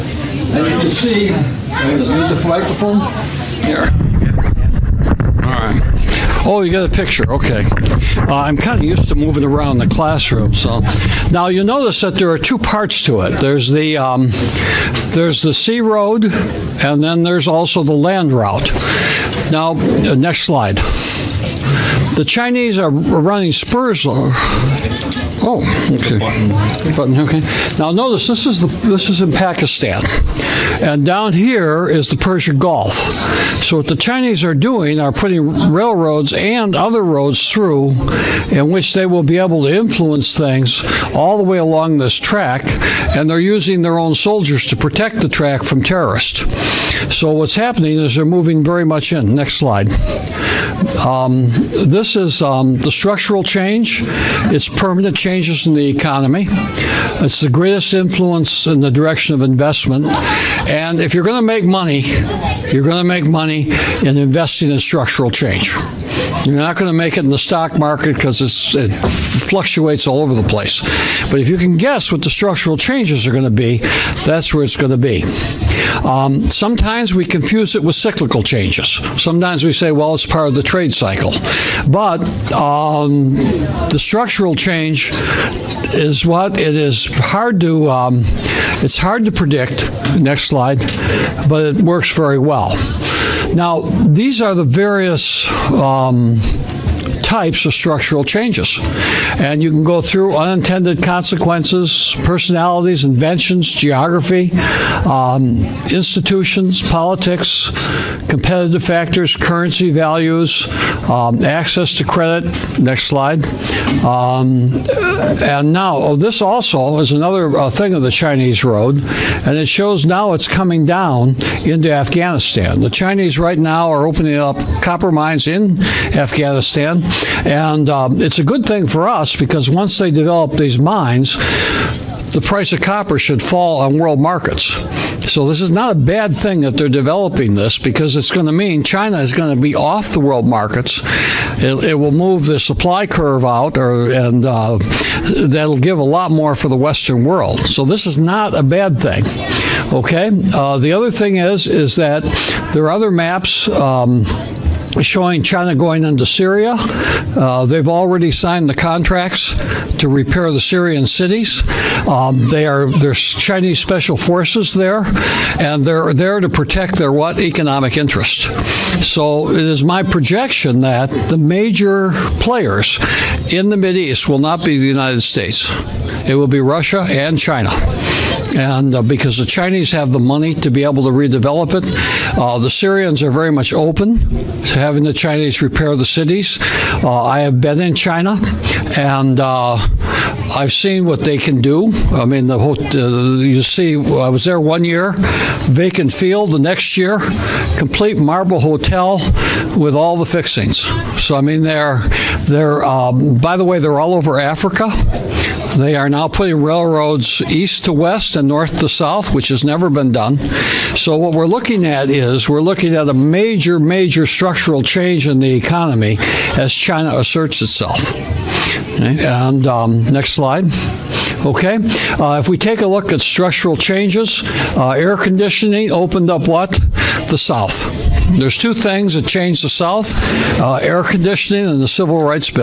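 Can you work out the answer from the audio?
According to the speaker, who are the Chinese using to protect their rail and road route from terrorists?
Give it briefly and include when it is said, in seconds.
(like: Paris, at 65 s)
Their own soldiers, at 43 s.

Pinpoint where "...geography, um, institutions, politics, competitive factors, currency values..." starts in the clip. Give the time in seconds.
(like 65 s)
103 s.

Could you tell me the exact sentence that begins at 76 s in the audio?
Um, sometimes we confuse it with cyclical changes.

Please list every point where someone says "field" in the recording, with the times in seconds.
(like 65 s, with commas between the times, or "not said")
196 s.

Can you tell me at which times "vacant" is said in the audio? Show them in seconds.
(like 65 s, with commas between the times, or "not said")
195 s.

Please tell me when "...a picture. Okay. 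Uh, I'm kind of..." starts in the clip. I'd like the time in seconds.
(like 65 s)
6 s.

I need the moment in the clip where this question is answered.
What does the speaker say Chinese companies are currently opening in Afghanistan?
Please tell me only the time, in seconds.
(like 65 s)
124 s.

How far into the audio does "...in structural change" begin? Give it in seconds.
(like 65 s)
64 s.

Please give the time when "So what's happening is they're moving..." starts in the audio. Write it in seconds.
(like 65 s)
47 s.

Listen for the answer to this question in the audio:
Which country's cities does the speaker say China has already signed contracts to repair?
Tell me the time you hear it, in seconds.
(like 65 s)
160 s.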